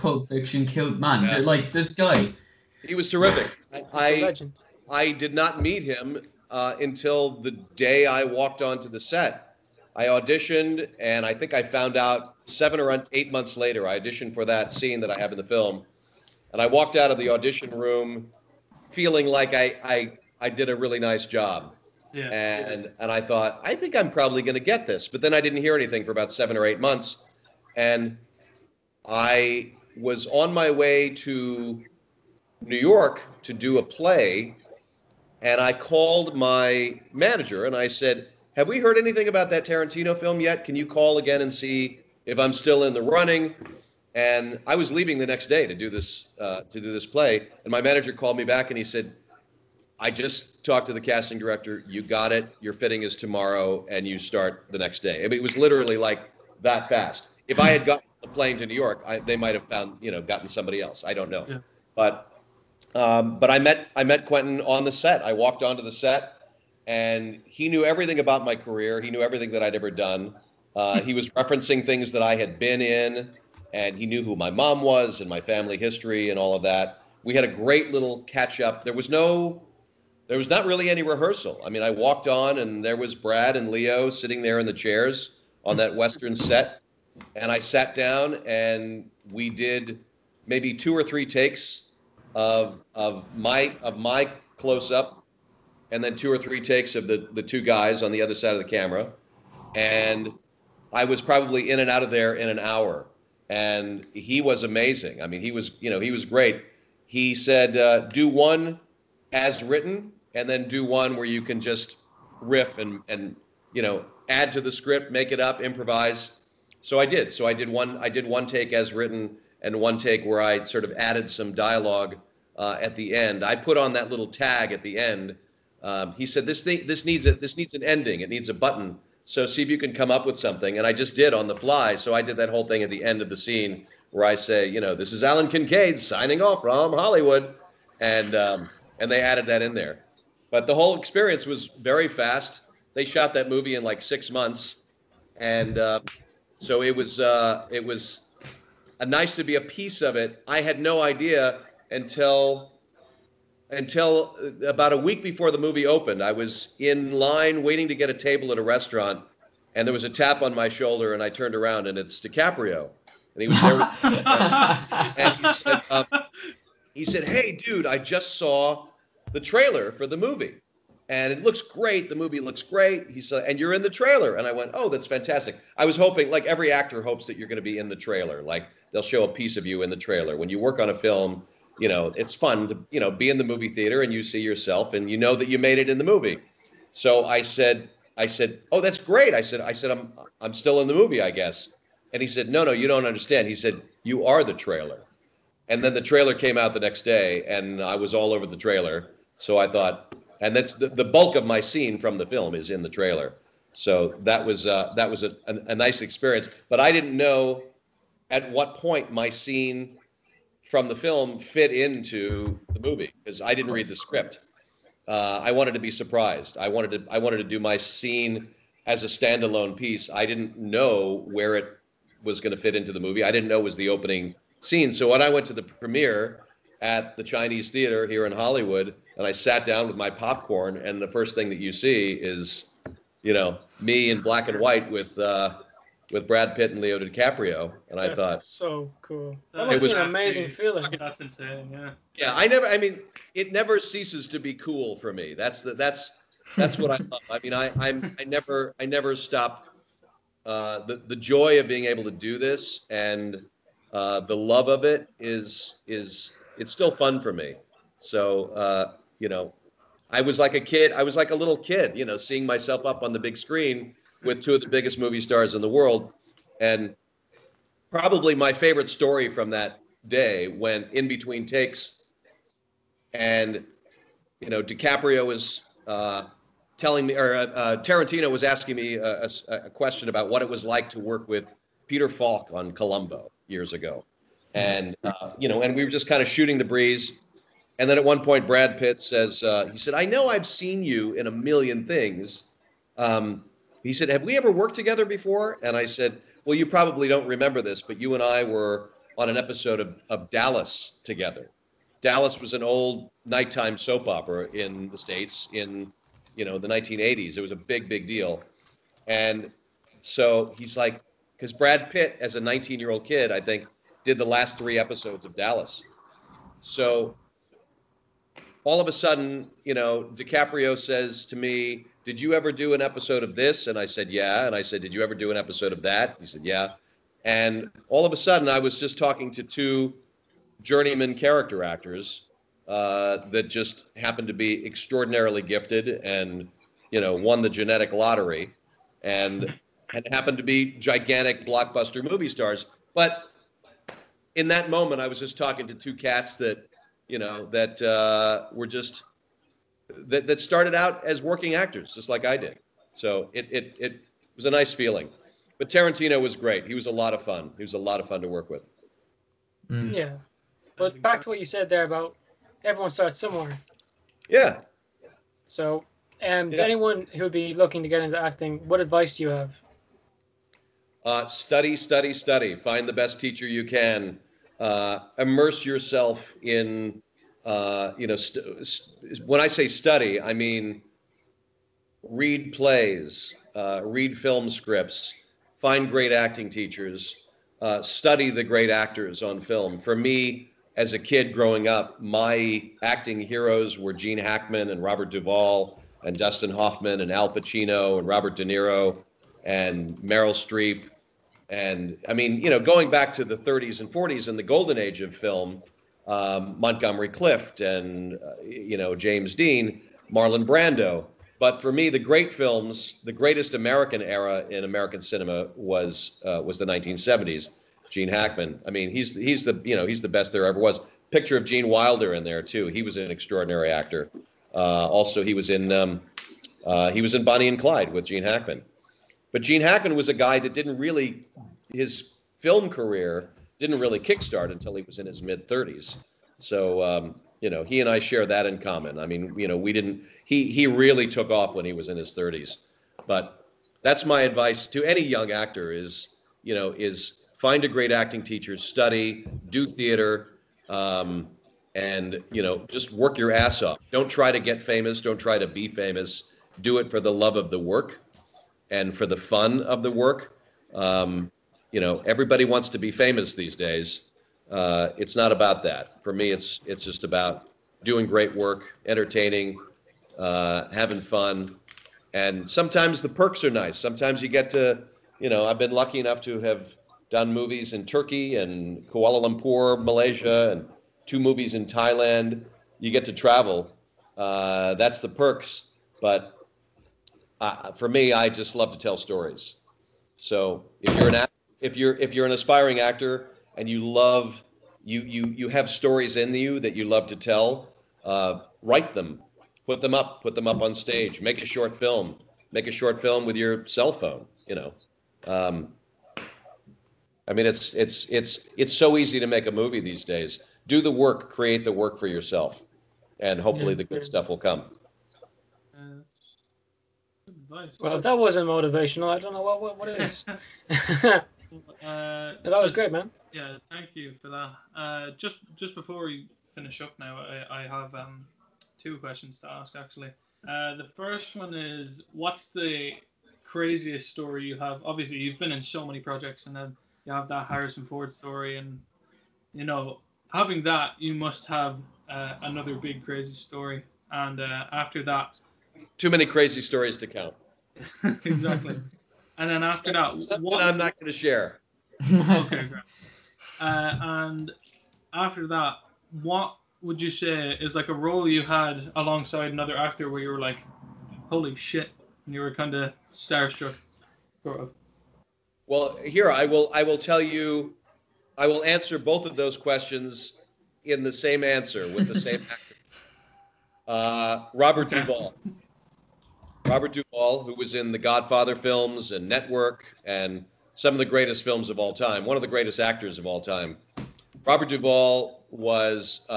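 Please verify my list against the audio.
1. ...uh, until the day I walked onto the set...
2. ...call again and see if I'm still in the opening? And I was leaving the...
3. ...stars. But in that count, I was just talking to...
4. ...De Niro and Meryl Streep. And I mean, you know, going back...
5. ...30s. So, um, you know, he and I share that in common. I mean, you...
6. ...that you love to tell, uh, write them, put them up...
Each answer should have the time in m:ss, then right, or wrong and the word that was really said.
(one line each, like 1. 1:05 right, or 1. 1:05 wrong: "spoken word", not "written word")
1. 0:06 right
2. 0:40 wrong: "running", not "opening"
3. 5:42 wrong: "moment", not "count"
4. 6:38 right
5. 7:15 right
6. 8:16 right.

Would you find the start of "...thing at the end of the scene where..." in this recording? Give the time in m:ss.
2:12.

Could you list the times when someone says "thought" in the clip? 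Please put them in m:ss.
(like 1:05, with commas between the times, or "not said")
0:23, 3:19, 3:58.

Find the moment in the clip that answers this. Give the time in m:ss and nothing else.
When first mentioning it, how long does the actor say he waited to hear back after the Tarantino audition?
0:12.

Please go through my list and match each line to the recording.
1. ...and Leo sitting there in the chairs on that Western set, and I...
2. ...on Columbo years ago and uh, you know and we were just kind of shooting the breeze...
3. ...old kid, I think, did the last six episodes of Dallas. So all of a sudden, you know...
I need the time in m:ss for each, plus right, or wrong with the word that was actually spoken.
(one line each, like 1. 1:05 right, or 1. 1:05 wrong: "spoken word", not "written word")
1. 1:23 right
2. 4:42 right
3. 5:12 wrong: "three", not "six".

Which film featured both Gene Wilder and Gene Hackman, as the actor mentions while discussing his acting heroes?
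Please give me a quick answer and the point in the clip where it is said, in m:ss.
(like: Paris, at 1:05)
Bonnie and Clyde, at 7:07.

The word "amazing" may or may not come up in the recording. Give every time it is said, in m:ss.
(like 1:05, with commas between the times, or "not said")
1:44, 4:00.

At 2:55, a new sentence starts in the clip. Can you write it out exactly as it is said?
I was hoping, like every actor hopes that you're going to be in the trailer.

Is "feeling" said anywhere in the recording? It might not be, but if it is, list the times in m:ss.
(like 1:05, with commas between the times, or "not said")
0:18, 4:00, 5:54.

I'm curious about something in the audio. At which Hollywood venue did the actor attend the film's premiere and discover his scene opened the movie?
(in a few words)
Chinese Theater.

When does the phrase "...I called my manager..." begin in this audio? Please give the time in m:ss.
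0:35.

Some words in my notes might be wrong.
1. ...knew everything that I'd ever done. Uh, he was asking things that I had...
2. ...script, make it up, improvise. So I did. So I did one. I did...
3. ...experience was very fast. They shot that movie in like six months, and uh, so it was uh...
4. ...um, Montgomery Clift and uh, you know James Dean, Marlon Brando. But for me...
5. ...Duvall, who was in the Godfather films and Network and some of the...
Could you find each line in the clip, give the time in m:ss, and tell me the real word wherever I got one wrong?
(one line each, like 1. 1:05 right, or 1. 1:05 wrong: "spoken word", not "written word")
1. 1:09 wrong: "referencing", not "asking"
2. 1:54 right
3. 2:20 right
4. 6:46 right
5. 9:36 right.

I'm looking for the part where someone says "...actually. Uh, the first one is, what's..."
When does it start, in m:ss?
8:49.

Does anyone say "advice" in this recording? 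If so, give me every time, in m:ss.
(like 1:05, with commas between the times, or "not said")
6:08, 7:24.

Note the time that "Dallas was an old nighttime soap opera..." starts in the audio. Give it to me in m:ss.
5:01.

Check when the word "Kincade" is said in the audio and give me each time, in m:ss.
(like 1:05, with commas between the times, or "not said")
2:15.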